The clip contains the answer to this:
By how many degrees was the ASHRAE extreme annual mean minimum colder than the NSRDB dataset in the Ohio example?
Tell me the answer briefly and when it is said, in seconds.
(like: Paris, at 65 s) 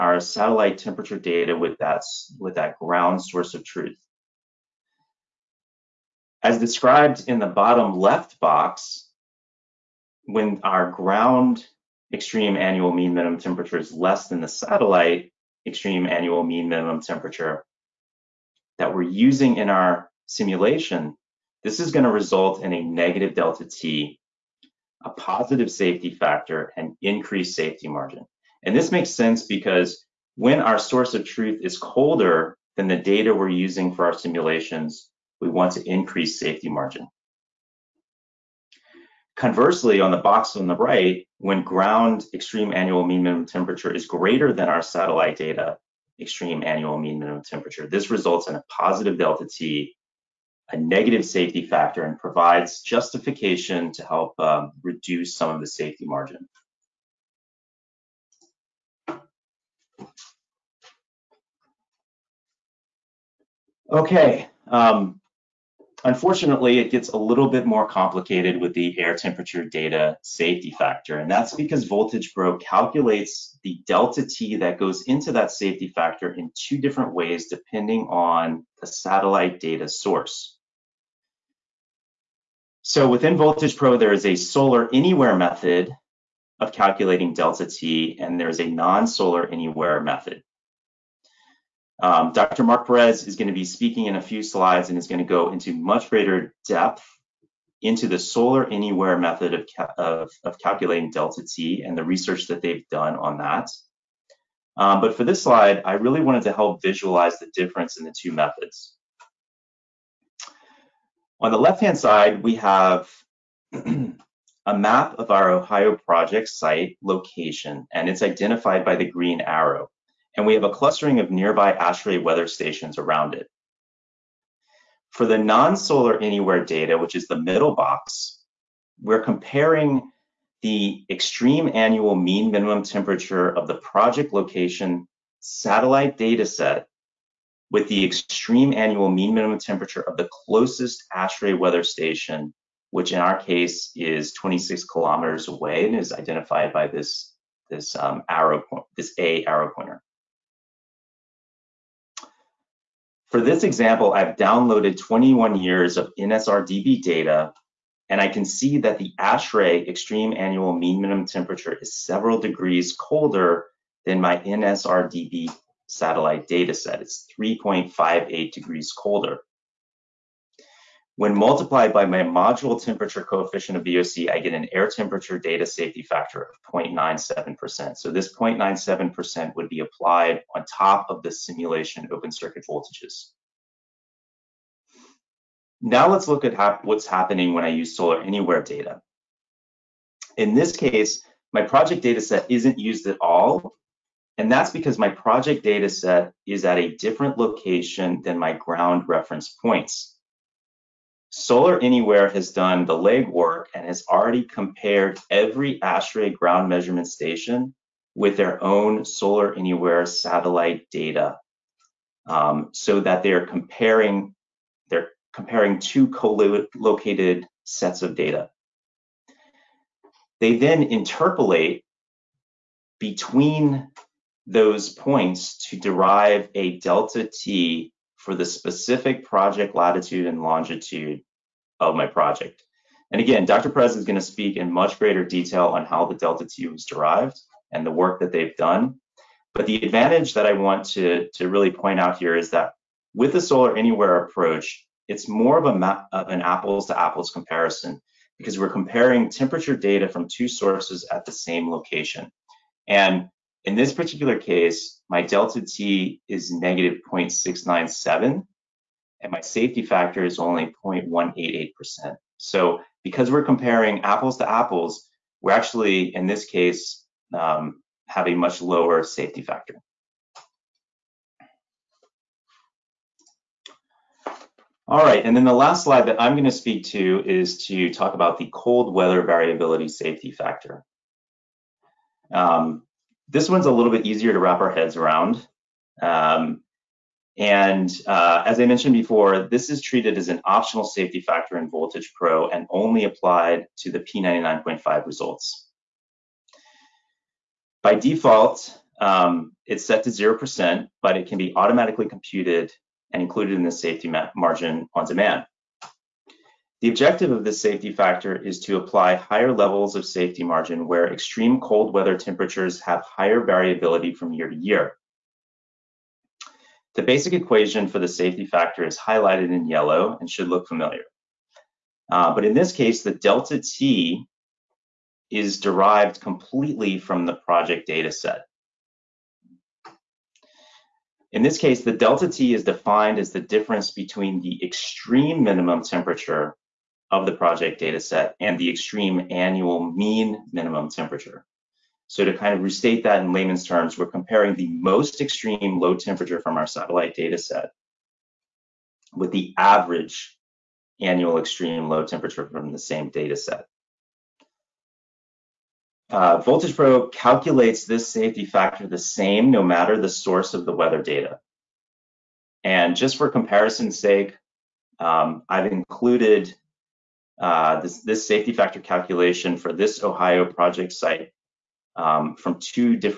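3.58, at 167 s.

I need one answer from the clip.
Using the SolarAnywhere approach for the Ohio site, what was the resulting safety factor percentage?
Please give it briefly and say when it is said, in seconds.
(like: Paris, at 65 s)
0.188%, at 260 s.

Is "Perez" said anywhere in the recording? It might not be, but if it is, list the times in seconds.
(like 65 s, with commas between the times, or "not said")
92 s, 233 s.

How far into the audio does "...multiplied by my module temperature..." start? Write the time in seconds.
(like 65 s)
171 s.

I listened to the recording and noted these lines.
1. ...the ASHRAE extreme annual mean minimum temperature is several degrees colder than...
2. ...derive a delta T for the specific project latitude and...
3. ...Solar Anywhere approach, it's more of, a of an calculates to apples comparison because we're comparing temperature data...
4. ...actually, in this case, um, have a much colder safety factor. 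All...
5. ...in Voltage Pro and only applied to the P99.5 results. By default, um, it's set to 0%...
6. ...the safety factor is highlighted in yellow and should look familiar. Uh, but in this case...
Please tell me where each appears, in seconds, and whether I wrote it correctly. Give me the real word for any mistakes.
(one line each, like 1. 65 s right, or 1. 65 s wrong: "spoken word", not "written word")
1. 158 s right
2. 225 s right
3. 243 s wrong: "apples", not "calculates"
4. 265 s wrong: "lower", not "colder"
5. 291 s right
6. 317 s right.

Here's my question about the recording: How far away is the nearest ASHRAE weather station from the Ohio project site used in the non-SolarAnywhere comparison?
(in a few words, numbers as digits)
26 kilometers.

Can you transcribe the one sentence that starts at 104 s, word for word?
Um, but for this slide, I really wanted to help visualize the difference in the two methods.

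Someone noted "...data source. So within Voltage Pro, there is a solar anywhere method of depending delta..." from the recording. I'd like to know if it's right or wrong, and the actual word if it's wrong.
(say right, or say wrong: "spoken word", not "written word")
wrong: "calculating", not "depending".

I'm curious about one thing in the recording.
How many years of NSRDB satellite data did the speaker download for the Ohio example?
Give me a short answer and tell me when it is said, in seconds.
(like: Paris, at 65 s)
21, at 154 s.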